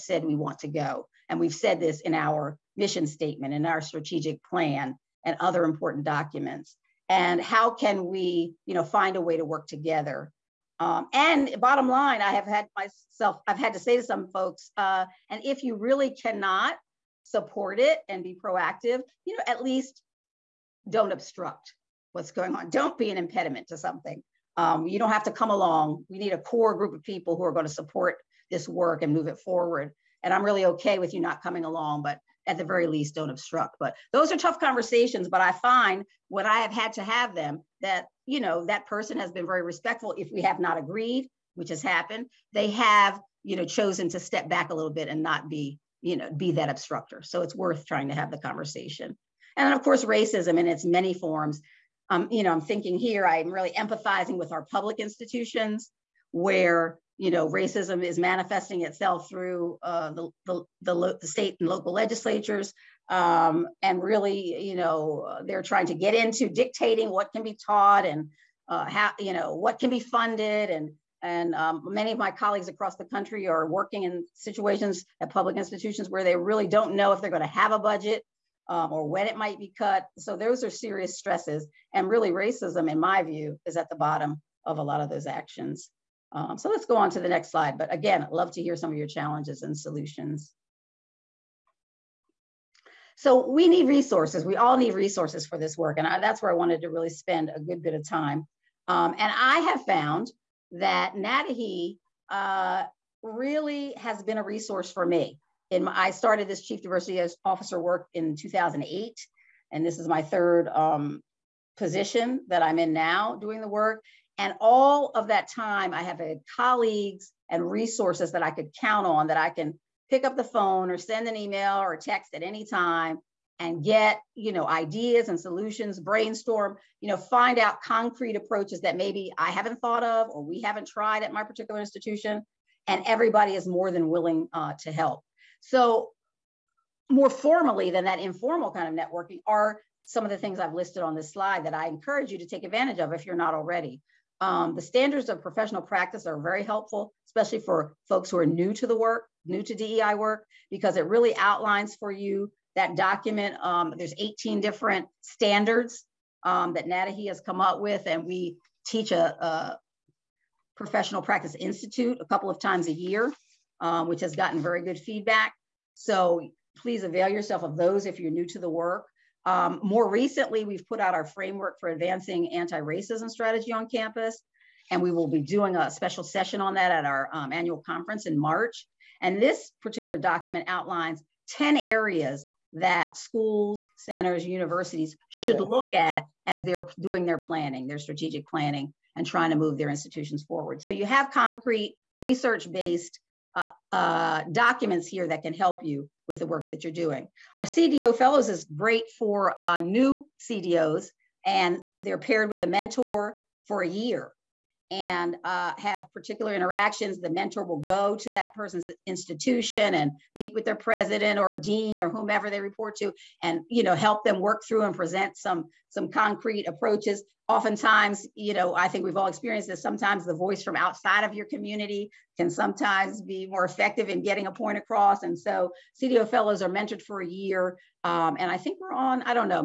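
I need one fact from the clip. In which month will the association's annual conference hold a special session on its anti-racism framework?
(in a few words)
March.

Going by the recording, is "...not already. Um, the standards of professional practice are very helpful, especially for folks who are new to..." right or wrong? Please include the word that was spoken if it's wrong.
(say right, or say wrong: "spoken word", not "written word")
right.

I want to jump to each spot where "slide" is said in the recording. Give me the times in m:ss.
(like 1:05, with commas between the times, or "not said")
1:27, 2:21.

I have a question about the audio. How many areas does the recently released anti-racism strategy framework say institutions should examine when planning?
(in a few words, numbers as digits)
10.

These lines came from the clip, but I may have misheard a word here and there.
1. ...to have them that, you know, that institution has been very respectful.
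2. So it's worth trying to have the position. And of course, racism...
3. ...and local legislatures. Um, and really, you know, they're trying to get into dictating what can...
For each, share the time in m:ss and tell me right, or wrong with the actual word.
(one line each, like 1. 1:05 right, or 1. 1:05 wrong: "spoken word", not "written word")
1. 0:36 wrong: "person", not "institution"
2. 0:47 wrong: "conversation", not "position"
3. 1:01 right.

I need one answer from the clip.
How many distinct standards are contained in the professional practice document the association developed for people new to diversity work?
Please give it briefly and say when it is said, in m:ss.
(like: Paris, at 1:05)
18, at 2:34.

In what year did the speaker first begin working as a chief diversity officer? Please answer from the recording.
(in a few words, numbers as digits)
2008.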